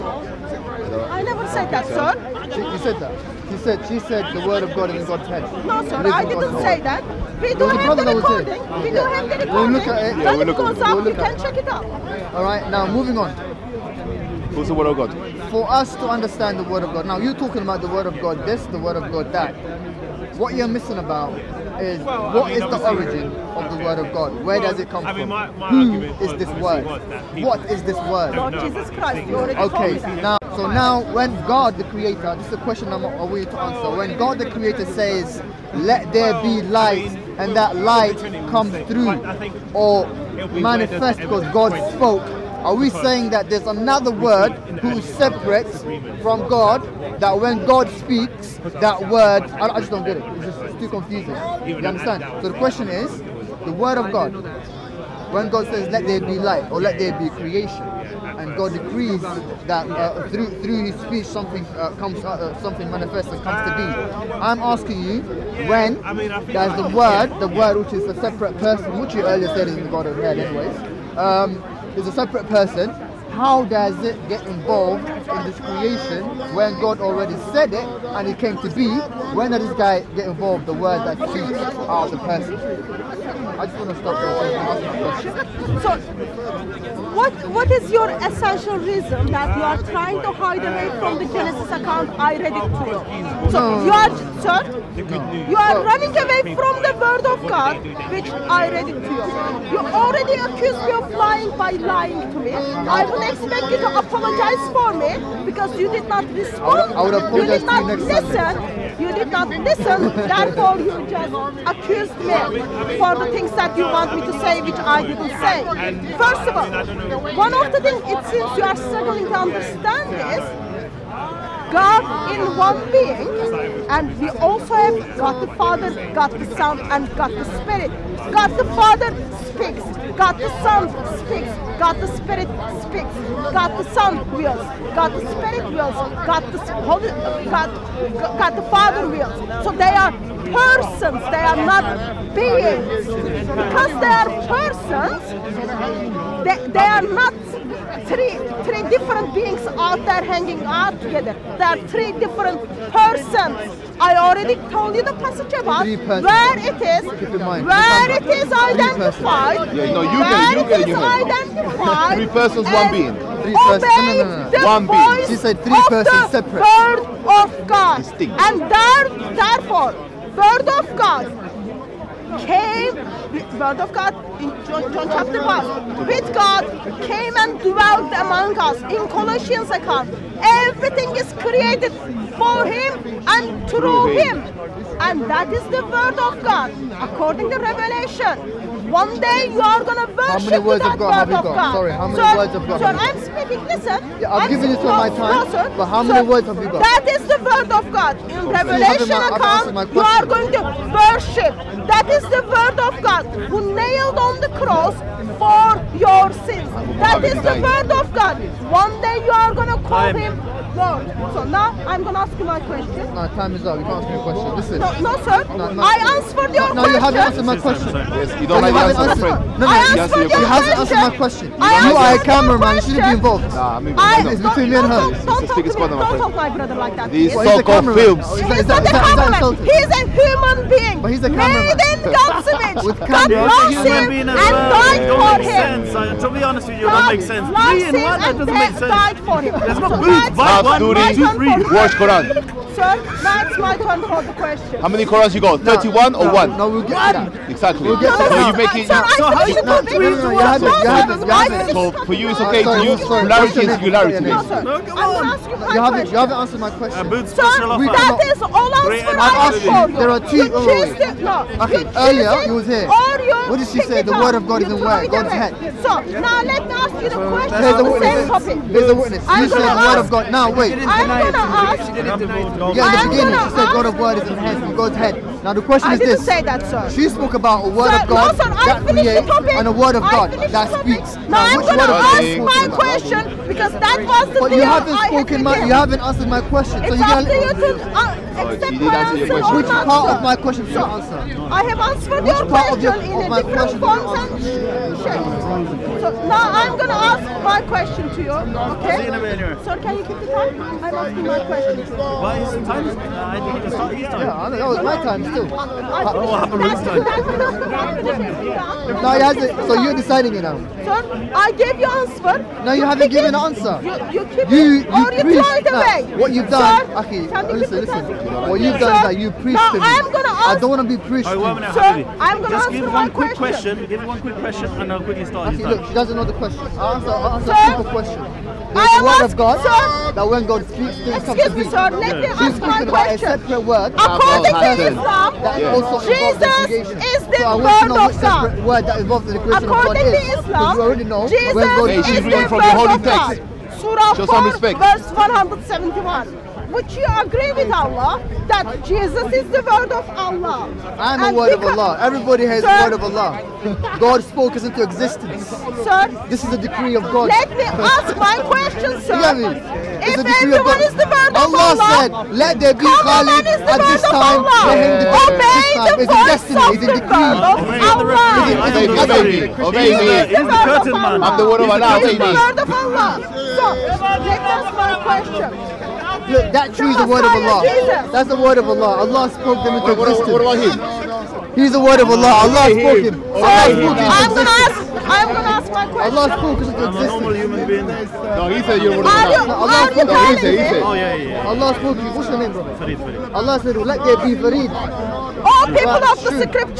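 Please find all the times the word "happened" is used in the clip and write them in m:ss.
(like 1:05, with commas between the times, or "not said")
5:06.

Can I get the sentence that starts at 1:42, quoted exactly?
I will expect you to apologize for me because you did not respond.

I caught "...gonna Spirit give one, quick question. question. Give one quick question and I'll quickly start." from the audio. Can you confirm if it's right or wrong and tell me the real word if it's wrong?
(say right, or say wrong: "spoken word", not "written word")
wrong: "Just", not "Spirit".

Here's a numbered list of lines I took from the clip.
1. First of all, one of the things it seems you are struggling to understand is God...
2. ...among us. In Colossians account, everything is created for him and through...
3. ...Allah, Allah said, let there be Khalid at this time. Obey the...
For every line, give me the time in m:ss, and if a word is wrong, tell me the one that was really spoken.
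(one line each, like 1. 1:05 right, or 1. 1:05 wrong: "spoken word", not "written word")
1. 1:56 right
2. 2:58 right
3. 6:01 right.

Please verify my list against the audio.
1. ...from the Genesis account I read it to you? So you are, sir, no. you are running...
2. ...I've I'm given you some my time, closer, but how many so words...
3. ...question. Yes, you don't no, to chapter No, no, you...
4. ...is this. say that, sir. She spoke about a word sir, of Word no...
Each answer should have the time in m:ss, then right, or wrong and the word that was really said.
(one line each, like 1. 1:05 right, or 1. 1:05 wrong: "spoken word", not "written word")
1. 1:30 right
2. 3:14 right
3. 3:37 wrong: "answer", not "chapter"
4. 4:35 wrong: "God", not "Word".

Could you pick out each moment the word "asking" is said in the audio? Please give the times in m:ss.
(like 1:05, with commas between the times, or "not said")
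1:04, 5:00.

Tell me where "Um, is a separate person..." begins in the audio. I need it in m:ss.
1:11.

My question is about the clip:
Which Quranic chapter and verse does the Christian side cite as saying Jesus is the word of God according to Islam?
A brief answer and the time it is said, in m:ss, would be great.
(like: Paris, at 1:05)
Surah 4, verse 171, at 5:43.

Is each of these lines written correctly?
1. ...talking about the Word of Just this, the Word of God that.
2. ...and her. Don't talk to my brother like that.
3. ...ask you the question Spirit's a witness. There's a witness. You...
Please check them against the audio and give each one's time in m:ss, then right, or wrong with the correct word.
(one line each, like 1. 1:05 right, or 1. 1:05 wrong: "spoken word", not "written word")
1. 0:17 wrong: "God", not "Just"
2. 3:44 right
3. 4:26 wrong: "There", not "Spirit".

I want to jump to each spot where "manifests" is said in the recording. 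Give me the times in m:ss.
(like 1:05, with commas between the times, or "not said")
0:40, 1:02.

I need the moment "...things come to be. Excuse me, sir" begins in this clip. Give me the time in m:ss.
5:31.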